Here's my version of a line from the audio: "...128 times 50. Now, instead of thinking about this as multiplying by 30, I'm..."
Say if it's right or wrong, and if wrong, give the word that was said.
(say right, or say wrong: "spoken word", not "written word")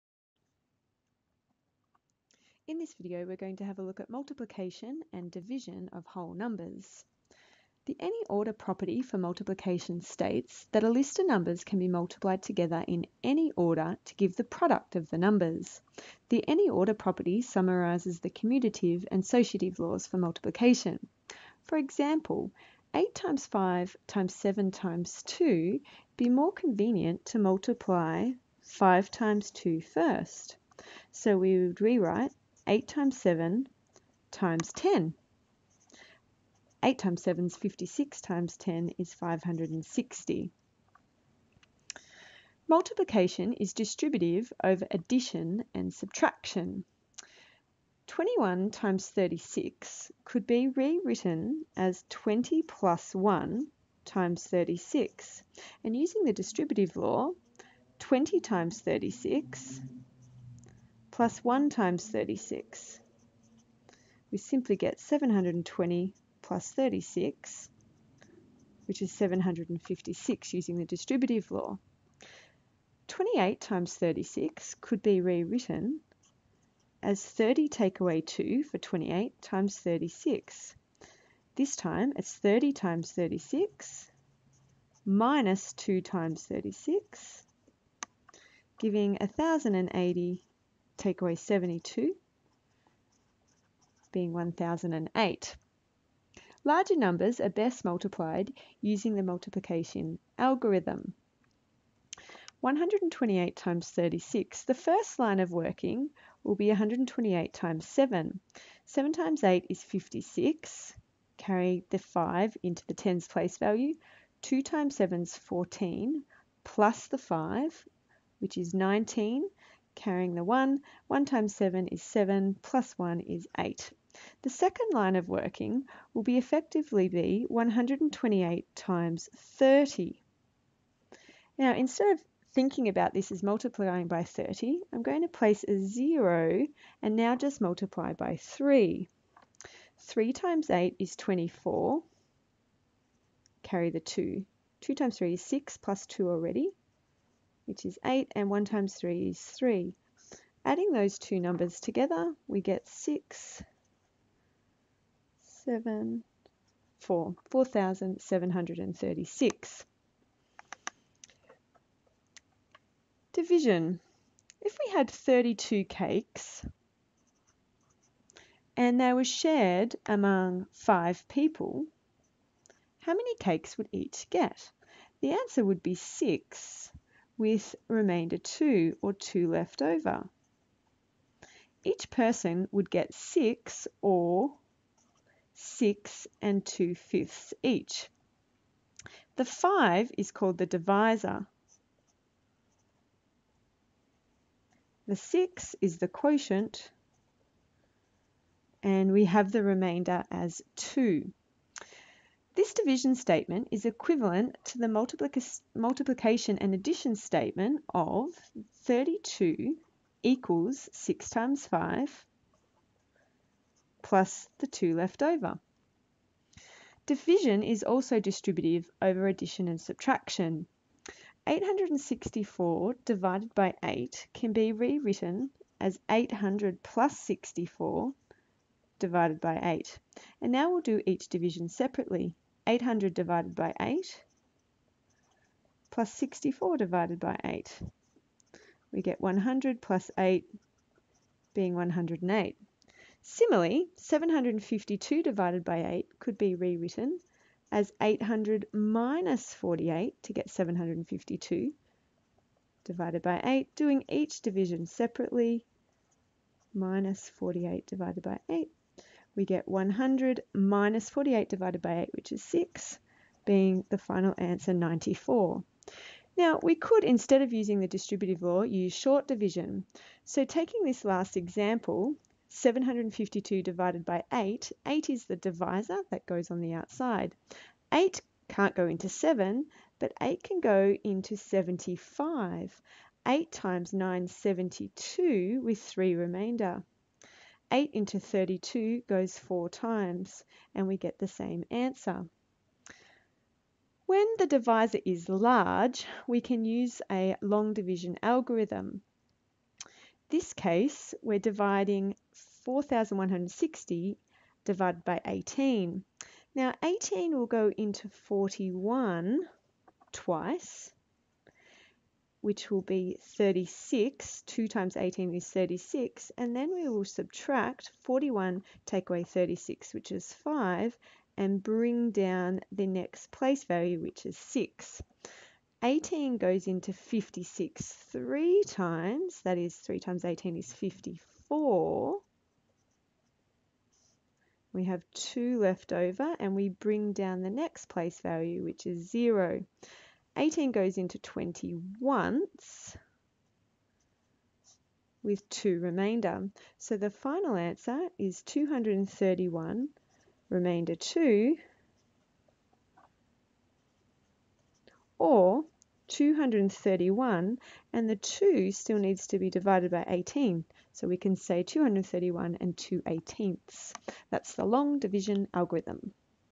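wrong: "30", not "50".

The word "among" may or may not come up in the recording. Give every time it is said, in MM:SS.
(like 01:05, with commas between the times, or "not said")
02:50.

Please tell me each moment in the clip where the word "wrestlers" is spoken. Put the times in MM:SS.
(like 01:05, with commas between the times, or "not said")
not said.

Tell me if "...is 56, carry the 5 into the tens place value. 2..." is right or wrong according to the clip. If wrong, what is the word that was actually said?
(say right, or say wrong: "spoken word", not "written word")
right.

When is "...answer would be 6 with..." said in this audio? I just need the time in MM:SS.
02:55.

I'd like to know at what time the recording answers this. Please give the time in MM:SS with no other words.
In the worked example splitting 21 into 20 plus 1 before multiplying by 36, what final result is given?
01:34.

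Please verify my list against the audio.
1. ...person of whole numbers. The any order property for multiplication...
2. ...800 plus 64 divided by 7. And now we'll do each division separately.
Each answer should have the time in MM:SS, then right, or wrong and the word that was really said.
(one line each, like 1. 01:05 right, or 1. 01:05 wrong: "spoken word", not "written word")
1. 00:05 wrong: "division", not "person"
2. 03:46 wrong: "8", not "7".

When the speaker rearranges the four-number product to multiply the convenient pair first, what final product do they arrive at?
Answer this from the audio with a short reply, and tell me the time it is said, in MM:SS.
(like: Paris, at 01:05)
560, at 00:39.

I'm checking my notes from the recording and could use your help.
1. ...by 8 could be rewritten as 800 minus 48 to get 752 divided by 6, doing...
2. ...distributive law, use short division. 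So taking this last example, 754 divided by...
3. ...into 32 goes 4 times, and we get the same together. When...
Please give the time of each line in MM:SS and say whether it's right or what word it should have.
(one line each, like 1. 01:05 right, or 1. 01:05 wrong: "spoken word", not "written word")
1. 04:05 wrong: "8", not "6"
2. 04:27 wrong: "752", not "754"
3. 04:47 wrong: "answer", not "together".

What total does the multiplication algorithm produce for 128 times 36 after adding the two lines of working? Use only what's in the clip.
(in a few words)
4,736.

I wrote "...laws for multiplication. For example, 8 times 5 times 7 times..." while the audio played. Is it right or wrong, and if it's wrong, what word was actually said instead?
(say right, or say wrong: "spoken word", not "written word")
right.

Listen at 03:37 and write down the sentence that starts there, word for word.
Division is also distributive over addition and subtraction.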